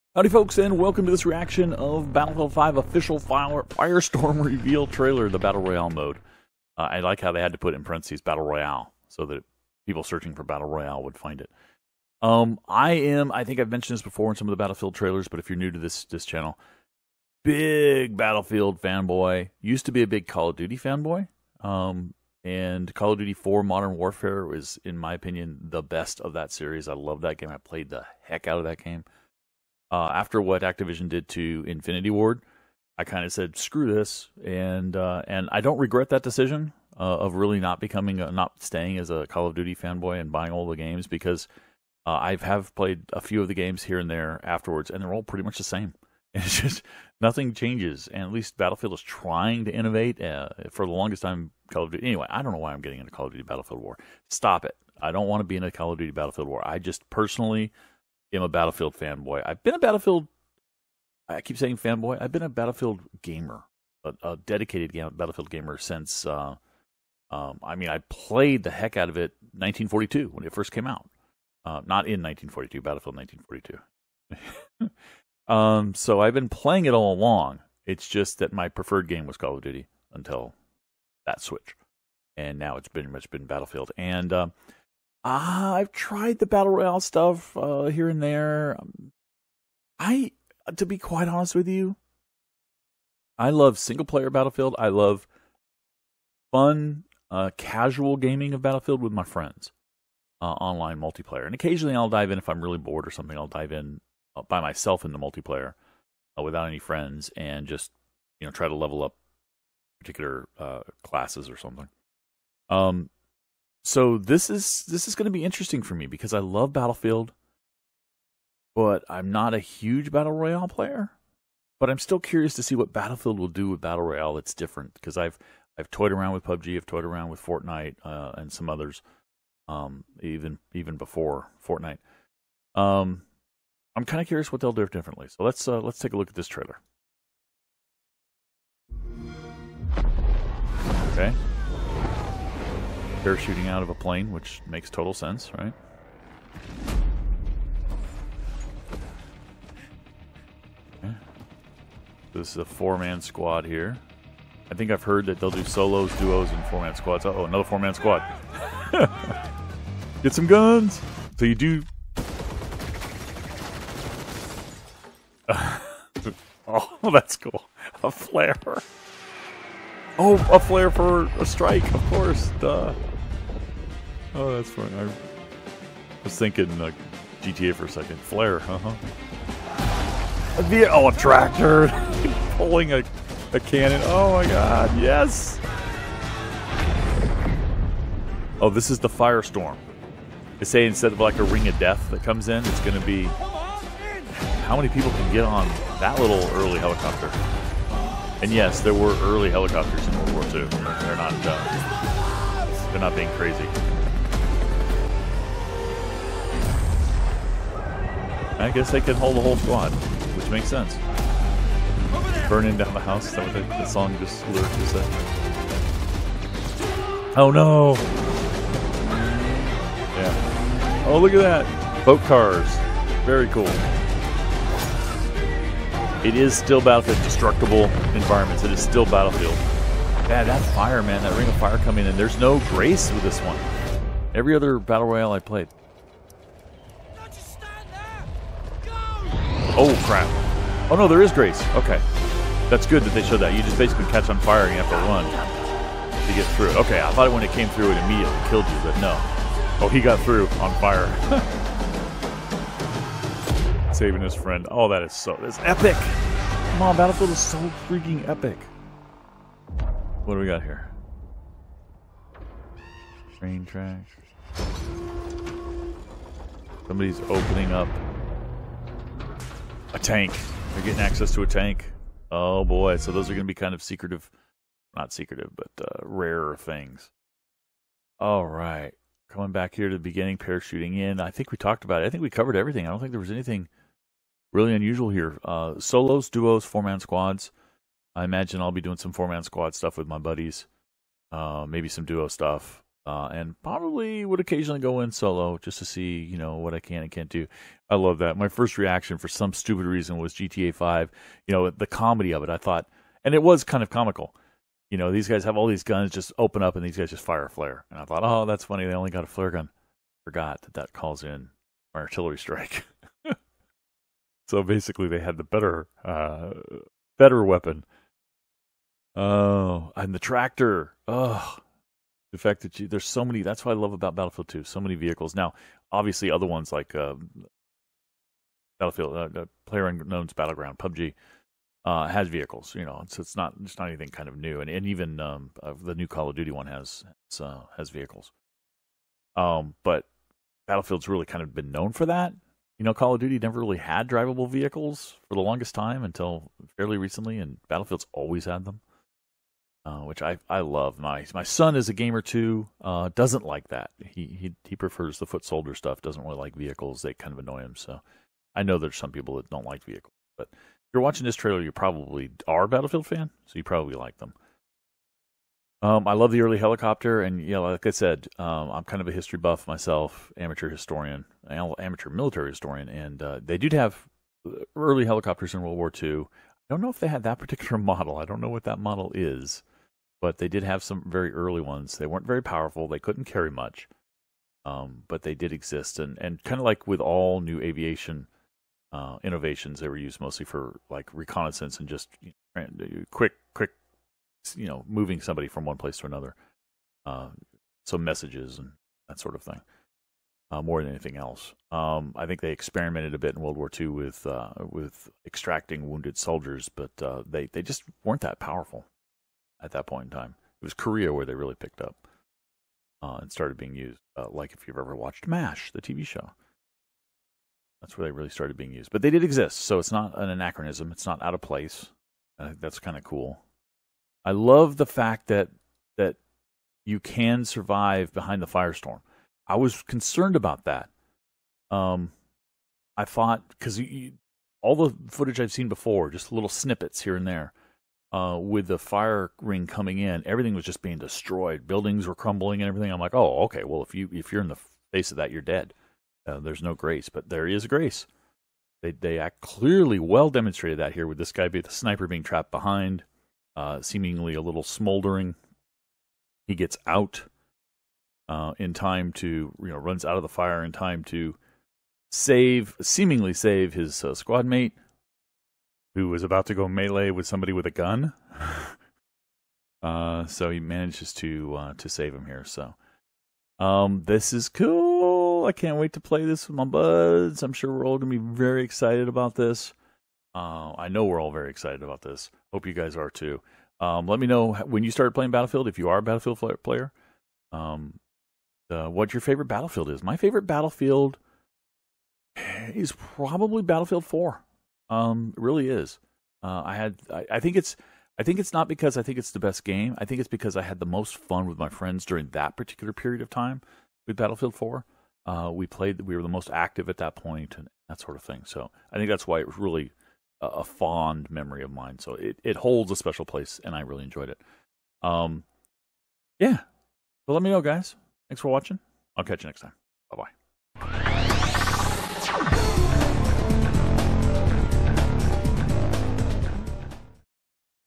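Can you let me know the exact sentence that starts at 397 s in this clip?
Uh, so messages and that sort of thing, uh, more than anything else.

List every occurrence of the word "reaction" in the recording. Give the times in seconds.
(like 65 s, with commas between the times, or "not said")
1 s, 298 s.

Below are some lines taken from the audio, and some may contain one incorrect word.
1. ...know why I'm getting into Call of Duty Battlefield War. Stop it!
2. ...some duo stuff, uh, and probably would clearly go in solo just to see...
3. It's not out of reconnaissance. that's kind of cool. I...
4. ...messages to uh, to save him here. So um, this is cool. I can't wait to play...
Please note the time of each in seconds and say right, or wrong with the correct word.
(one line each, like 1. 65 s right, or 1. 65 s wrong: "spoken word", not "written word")
1. 52 s right
2. 291 s wrong: "occasionally", not "clearly"
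3. 420 s wrong: "place", not "reconnaissance"
4. 470 s wrong: "manages", not "messages".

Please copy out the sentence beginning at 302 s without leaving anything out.
I thought, and it was kind of comical.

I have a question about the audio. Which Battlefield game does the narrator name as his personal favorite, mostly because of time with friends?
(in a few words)
Battlefield 4.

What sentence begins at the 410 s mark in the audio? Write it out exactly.
It was Korea where they really picked up uh, and started being used.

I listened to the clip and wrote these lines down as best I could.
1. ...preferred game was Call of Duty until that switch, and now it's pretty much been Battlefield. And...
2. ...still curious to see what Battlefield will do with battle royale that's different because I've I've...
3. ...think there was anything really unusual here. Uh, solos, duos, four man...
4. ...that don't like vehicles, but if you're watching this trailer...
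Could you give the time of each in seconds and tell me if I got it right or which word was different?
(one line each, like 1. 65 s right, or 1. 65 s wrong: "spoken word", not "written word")
1. 78 s right
2. 121 s right
3. 282 s right
4. 359 s right.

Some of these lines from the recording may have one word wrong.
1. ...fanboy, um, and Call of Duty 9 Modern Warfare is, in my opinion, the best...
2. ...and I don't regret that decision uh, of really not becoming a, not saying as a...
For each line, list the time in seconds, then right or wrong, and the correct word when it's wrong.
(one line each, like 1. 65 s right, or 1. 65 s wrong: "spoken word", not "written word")
1. 20 s wrong: "4", not "9"
2. 35 s wrong: "staying", not "saying".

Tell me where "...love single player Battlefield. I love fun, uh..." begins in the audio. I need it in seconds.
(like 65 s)
93 s.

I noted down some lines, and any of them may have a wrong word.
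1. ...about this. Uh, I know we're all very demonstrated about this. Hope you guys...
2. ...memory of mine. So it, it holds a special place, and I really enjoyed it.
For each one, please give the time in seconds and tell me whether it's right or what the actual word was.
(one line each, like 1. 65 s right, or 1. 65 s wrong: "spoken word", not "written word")
1. 479 s wrong: "excited", not "demonstrated"
2. 511 s right.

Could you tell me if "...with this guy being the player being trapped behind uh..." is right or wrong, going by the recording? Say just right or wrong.
wrong.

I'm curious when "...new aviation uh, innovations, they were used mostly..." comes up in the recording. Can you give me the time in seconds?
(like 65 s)
387 s.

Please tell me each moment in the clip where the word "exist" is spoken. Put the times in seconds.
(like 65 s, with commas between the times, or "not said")
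385 s, 419 s.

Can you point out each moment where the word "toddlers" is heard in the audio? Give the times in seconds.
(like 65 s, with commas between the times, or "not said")
not said.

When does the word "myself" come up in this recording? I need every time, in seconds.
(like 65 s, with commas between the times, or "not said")
104 s, 369 s.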